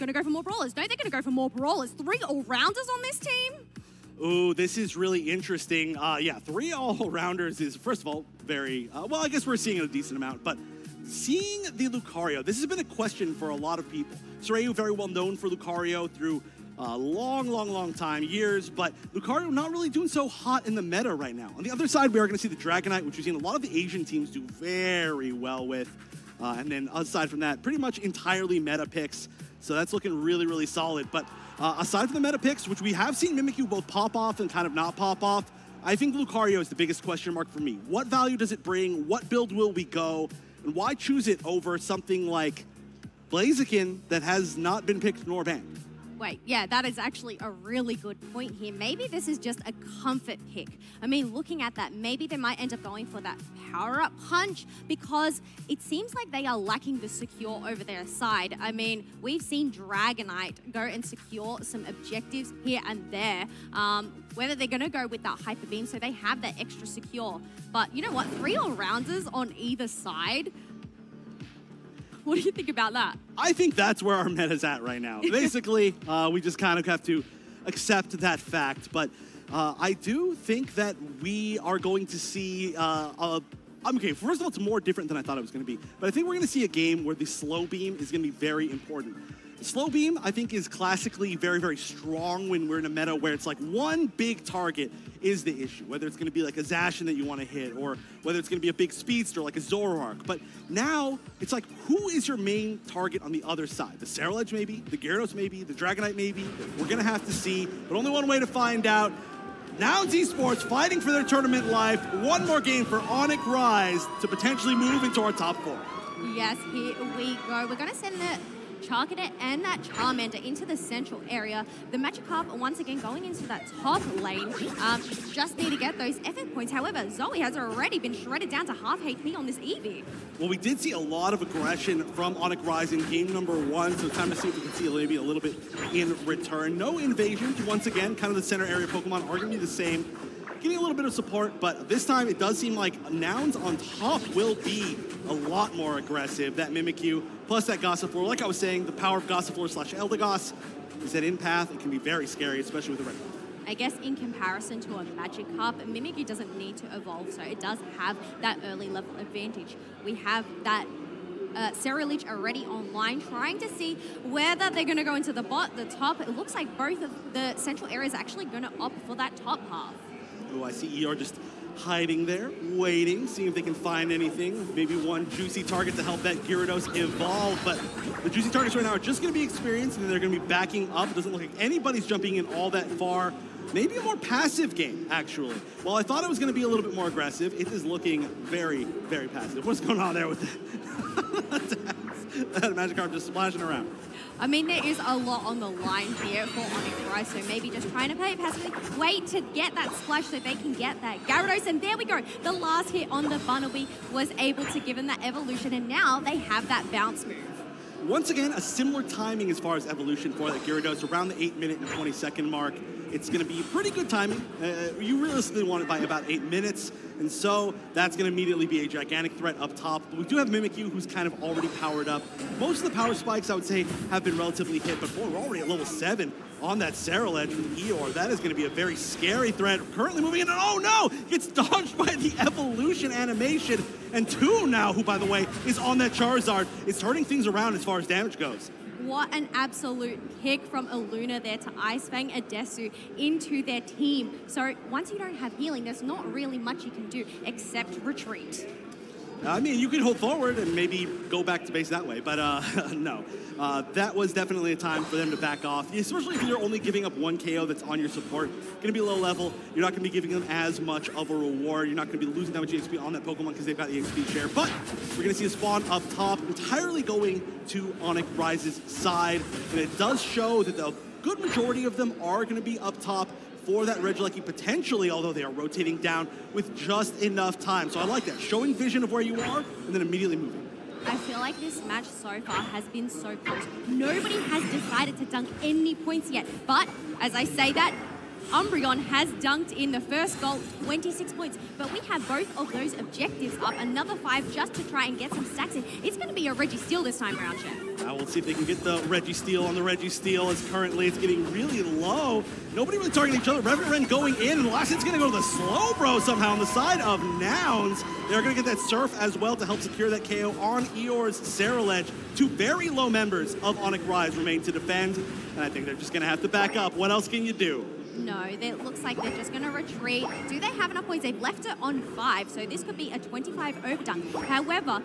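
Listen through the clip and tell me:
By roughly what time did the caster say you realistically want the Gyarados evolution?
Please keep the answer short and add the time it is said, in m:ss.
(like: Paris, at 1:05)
8 minutes, at 3:36.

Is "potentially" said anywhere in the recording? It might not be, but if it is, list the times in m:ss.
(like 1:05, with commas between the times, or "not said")
1:54, 4:34.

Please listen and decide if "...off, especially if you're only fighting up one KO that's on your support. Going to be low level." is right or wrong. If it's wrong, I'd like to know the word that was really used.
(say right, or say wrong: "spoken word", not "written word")
wrong: "giving", not "fighting".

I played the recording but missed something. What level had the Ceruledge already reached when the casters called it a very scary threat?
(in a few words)
7.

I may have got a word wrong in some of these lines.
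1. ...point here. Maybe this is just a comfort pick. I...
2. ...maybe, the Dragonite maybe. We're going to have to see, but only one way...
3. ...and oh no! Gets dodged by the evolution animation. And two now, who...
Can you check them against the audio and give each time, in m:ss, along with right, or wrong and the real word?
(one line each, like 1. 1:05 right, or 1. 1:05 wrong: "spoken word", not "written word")
1. 0:48 right
2. 1:45 right
3. 3:50 right.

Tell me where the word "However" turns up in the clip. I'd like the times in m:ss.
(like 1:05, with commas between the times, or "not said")
2:06, 5:24.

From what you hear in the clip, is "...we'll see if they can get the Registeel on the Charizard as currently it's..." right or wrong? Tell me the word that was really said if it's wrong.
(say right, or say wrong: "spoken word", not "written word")
wrong: "Registeel", not "Charizard".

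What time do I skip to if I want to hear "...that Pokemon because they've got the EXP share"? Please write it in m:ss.
4:23.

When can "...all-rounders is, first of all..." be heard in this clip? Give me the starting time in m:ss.
0:06.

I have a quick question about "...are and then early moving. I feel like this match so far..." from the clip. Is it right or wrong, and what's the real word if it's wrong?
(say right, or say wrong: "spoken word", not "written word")
wrong: "immediately", not "early".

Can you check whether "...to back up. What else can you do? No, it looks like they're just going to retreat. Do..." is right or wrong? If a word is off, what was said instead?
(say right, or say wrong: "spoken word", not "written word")
right.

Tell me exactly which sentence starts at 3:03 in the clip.
Maybe a more passive game, actually.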